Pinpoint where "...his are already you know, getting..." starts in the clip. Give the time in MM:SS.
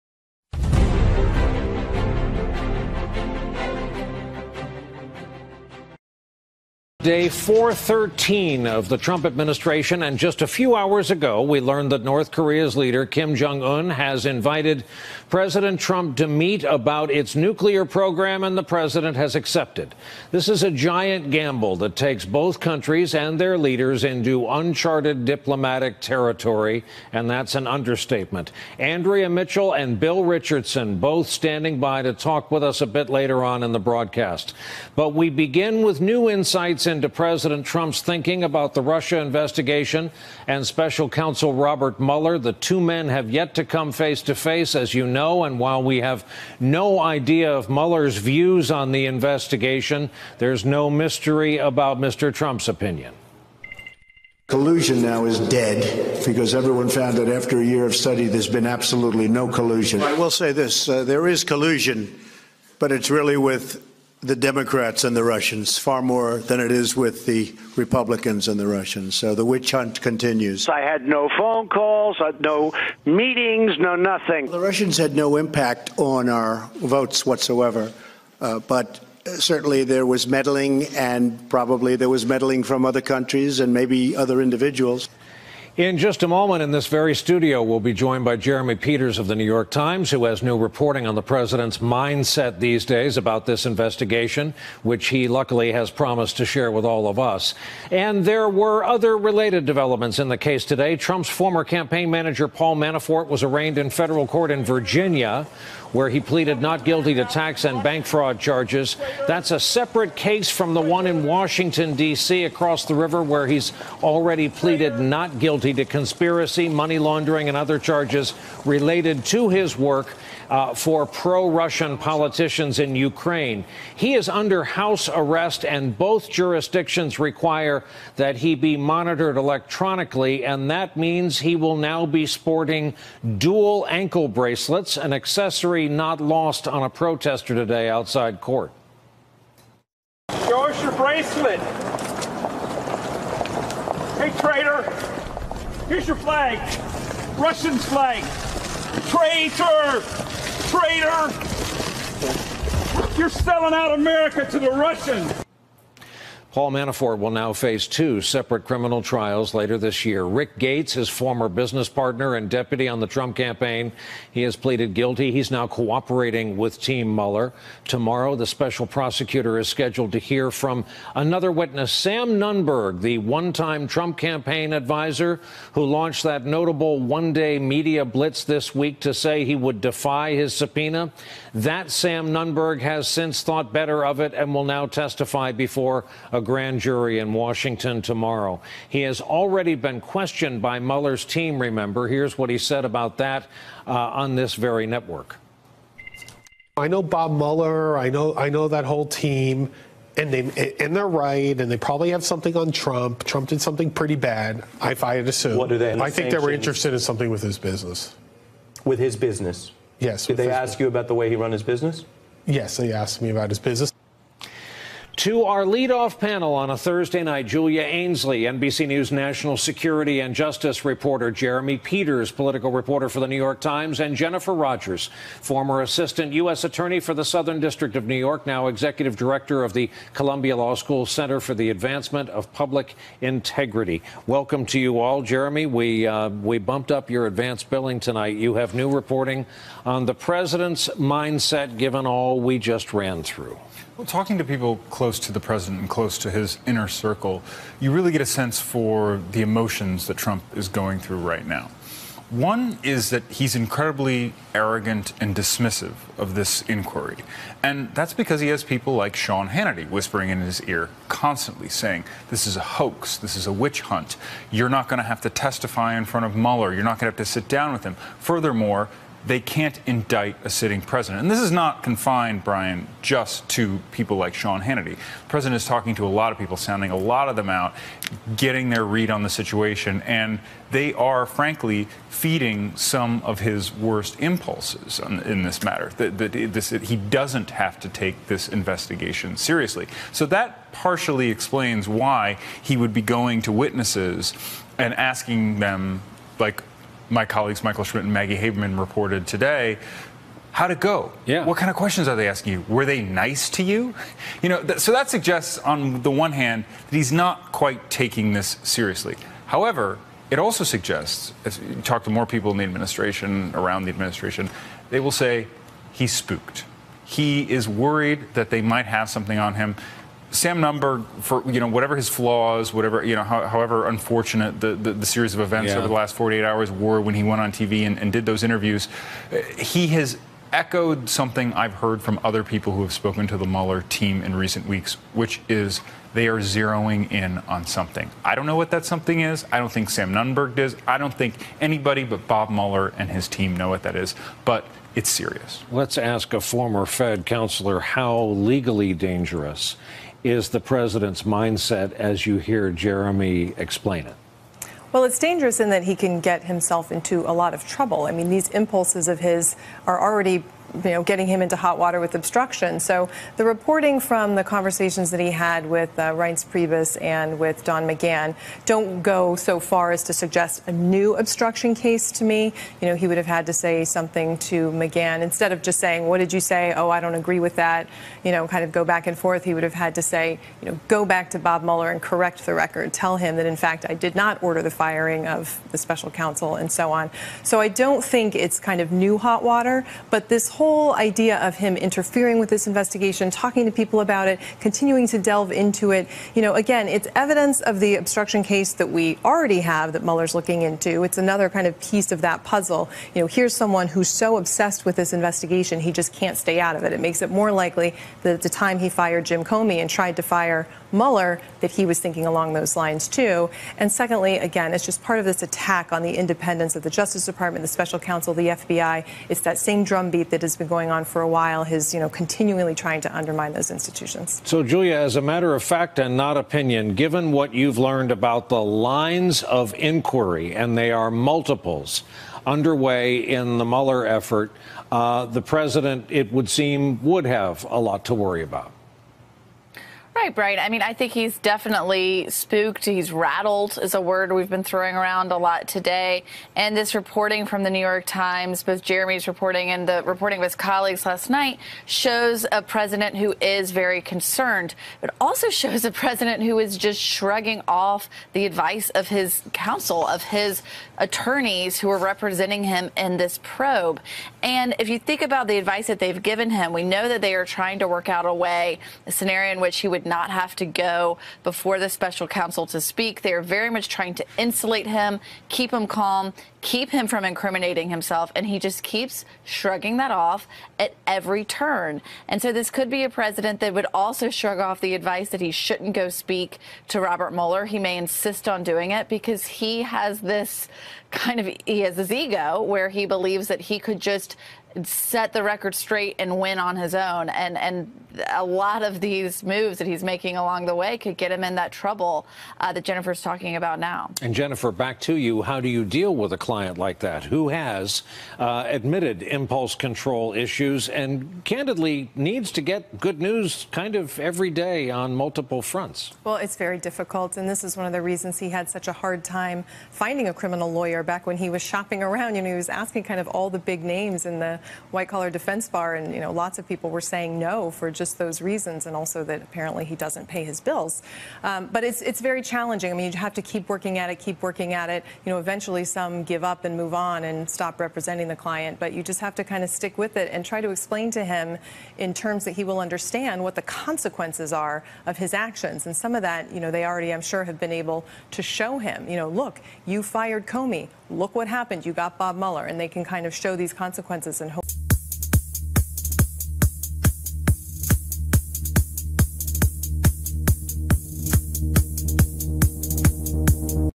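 05:59.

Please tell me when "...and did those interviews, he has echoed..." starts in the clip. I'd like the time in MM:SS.
05:27.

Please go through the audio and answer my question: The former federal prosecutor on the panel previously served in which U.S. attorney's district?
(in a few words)
Southern District of New York.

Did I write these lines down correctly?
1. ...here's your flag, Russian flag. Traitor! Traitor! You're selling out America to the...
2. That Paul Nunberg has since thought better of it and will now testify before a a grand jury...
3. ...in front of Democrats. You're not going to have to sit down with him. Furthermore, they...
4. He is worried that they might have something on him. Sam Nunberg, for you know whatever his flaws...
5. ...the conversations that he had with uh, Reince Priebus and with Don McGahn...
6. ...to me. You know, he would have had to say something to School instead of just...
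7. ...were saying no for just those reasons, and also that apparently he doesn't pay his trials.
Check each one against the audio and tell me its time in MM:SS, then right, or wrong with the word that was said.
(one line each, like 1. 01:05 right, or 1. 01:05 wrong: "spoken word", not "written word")
1. 02:25 right
2. 03:01 wrong: "Sam", not "Paul"
3. 04:25 wrong: "Mueller", not "Democrats"
4. 05:17 right
5. 06:04 right
6. 06:12 wrong: "McGahn", not "School"
7. 08:46 wrong: "bills", not "trials".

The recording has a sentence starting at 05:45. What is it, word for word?
Let's ask a former Fed counselor how legally dangerous is the president's mindset as you hear Jeremy explain it?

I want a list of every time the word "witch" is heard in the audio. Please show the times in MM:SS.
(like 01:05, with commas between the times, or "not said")
01:09, 04:23.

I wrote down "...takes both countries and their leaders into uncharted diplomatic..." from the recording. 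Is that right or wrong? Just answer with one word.
right.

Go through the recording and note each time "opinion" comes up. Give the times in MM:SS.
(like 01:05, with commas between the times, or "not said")
00:52, 07:06.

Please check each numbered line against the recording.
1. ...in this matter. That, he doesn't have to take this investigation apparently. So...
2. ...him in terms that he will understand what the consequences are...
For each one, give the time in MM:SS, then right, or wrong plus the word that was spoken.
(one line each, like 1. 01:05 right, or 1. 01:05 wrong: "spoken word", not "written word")
1. 04:44 wrong: "seriously", not "apparently"
2. 09:01 right.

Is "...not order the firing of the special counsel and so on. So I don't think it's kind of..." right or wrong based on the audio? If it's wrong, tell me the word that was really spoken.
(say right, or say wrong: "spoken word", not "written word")
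right.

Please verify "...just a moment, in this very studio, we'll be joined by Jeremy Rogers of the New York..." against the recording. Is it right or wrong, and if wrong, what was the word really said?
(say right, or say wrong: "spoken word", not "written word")
wrong: "Peters", not "Rogers".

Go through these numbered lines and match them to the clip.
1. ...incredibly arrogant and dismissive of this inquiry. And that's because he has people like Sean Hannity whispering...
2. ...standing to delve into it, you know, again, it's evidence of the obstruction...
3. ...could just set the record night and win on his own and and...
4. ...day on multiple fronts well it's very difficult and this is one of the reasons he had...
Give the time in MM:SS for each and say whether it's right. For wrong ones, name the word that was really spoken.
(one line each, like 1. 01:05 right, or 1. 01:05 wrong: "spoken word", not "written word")
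1. 04:13 right
2. 06:34 wrong: "continuing", not "standing"
3. 08:13 wrong: "straight", not "night"
4. 08:34 right.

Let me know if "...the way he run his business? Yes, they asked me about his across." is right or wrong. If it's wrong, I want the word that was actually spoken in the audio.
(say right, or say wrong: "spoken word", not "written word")
wrong: "business", not "across".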